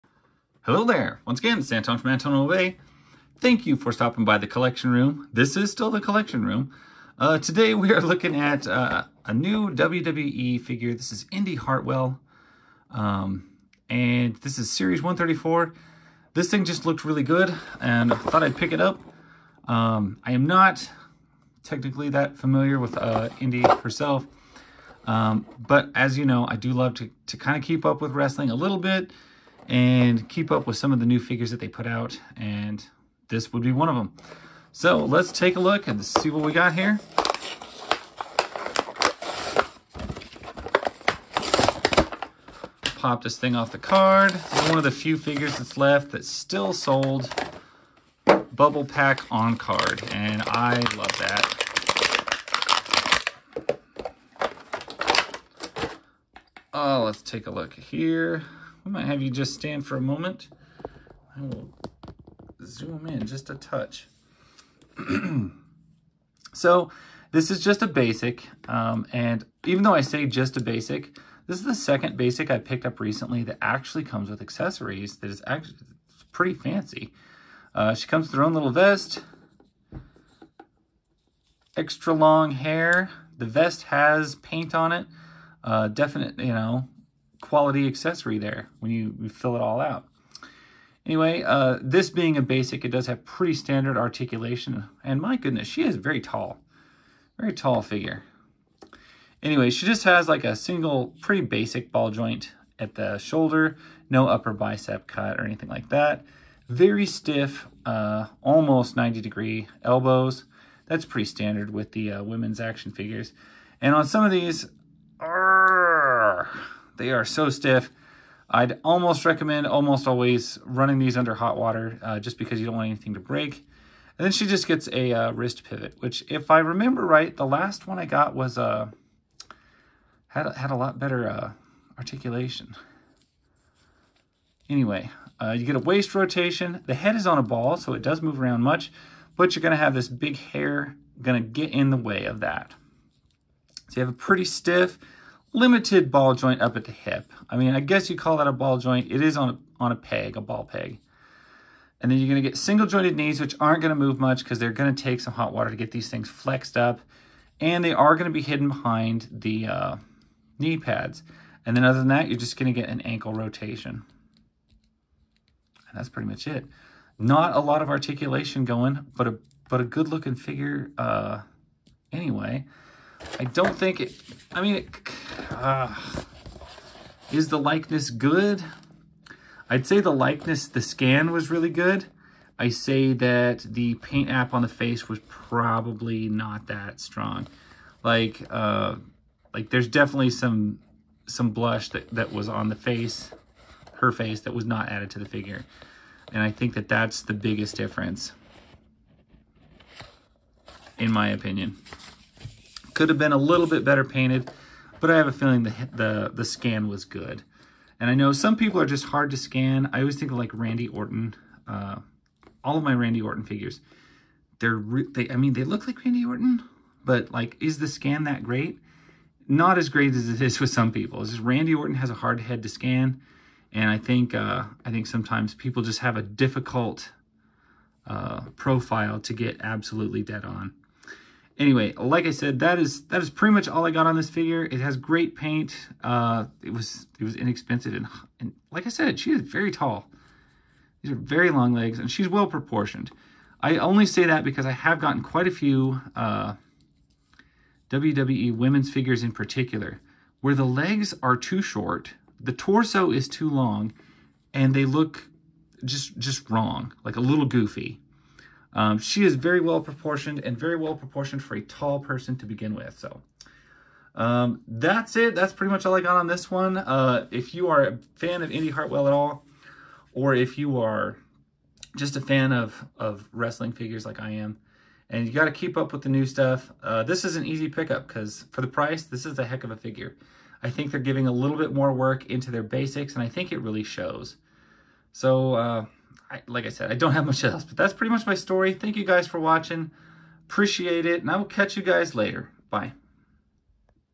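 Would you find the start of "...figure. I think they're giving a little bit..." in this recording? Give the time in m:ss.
4:39.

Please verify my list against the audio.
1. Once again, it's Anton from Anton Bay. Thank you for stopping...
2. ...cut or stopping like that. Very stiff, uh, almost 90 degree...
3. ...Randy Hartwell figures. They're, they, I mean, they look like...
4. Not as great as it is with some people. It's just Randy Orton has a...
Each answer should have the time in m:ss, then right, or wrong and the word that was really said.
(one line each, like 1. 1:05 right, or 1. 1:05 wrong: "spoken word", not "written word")
1. 0:01 right
2. 1:45 wrong: "anything", not "stopping"
3. 3:32 wrong: "Orton", not "Hartwell"
4. 3:39 right.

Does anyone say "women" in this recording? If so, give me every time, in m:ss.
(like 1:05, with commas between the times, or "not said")
1:52, 4:08.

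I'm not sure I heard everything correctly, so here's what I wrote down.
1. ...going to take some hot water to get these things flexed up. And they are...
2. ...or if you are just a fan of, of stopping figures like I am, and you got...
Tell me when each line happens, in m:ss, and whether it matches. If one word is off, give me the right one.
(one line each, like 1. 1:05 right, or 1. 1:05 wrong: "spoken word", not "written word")
1. 2:34 right
2. 4:30 wrong: "wrestling", not "stopping".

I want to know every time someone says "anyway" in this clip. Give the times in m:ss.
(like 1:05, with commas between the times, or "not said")
1:31, 1:39, 2:14, 2:52, 3:51.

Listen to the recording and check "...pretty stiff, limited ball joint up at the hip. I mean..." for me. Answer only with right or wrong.
right.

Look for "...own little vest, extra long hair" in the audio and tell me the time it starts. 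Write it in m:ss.
1:18.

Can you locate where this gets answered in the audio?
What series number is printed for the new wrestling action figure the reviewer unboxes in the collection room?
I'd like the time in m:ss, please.
0:14.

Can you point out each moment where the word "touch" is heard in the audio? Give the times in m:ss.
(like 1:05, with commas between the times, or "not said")
1:03.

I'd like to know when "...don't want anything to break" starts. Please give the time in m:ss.
2:02.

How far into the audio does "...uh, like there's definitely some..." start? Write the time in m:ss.
3:08.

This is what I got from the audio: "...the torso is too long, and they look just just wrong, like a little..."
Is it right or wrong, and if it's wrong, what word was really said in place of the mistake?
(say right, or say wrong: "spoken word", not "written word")
right.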